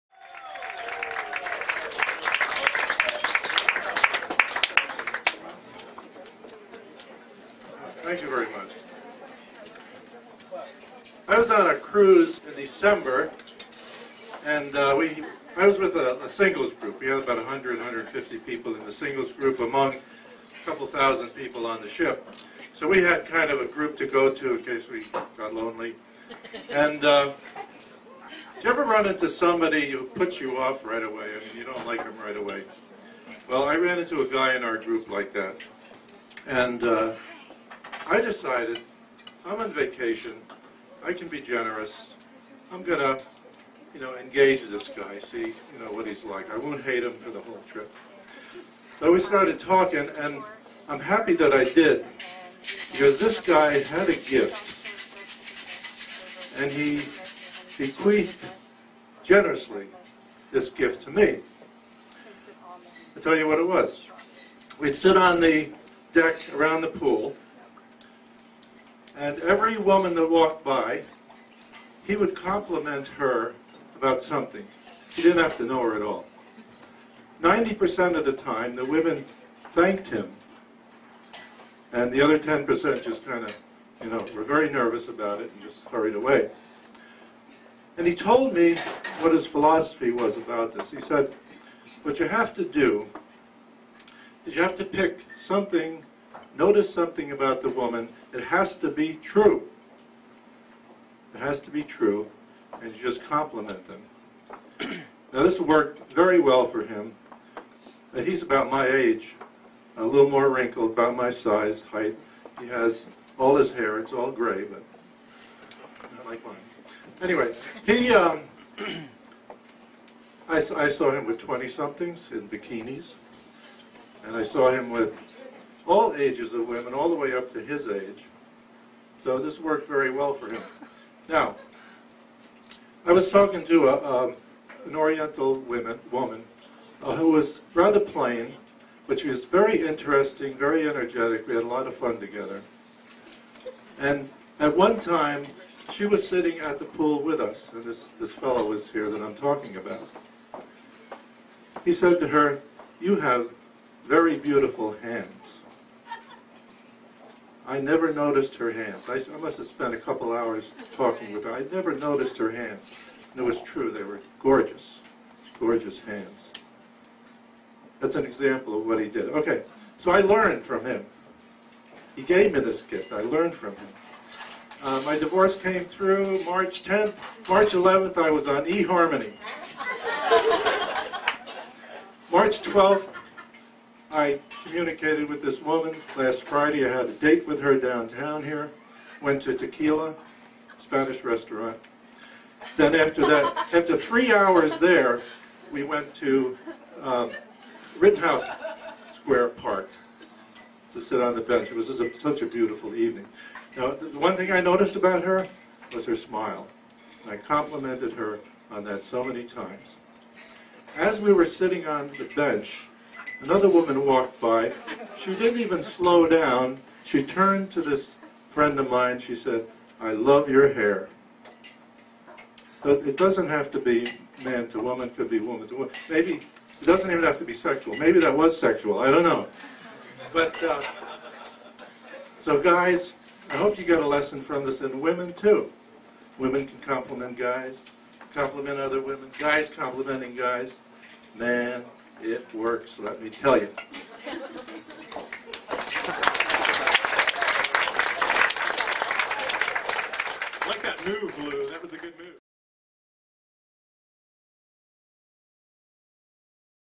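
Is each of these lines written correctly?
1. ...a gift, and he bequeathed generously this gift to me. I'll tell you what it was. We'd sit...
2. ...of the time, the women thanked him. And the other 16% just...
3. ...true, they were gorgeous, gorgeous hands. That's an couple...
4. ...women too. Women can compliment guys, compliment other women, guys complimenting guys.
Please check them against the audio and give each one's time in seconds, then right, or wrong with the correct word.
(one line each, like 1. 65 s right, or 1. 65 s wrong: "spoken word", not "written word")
1. 54 s right
2. 78 s wrong: "10", not "16"
3. 163 s wrong: "example", not "couple"
4. 235 s right.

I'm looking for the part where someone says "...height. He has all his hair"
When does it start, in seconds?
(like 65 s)
111 s.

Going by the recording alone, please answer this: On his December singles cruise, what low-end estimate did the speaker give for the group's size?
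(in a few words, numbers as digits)
100.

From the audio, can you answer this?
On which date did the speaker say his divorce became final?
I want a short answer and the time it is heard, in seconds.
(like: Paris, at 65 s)
March 10th, at 176 s.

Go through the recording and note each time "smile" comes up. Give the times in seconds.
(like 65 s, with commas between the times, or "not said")
206 s.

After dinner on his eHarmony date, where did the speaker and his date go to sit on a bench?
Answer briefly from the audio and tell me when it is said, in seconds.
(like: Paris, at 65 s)
Rittenhouse Square Park, at 197 s.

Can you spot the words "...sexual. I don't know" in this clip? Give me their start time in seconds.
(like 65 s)
228 s.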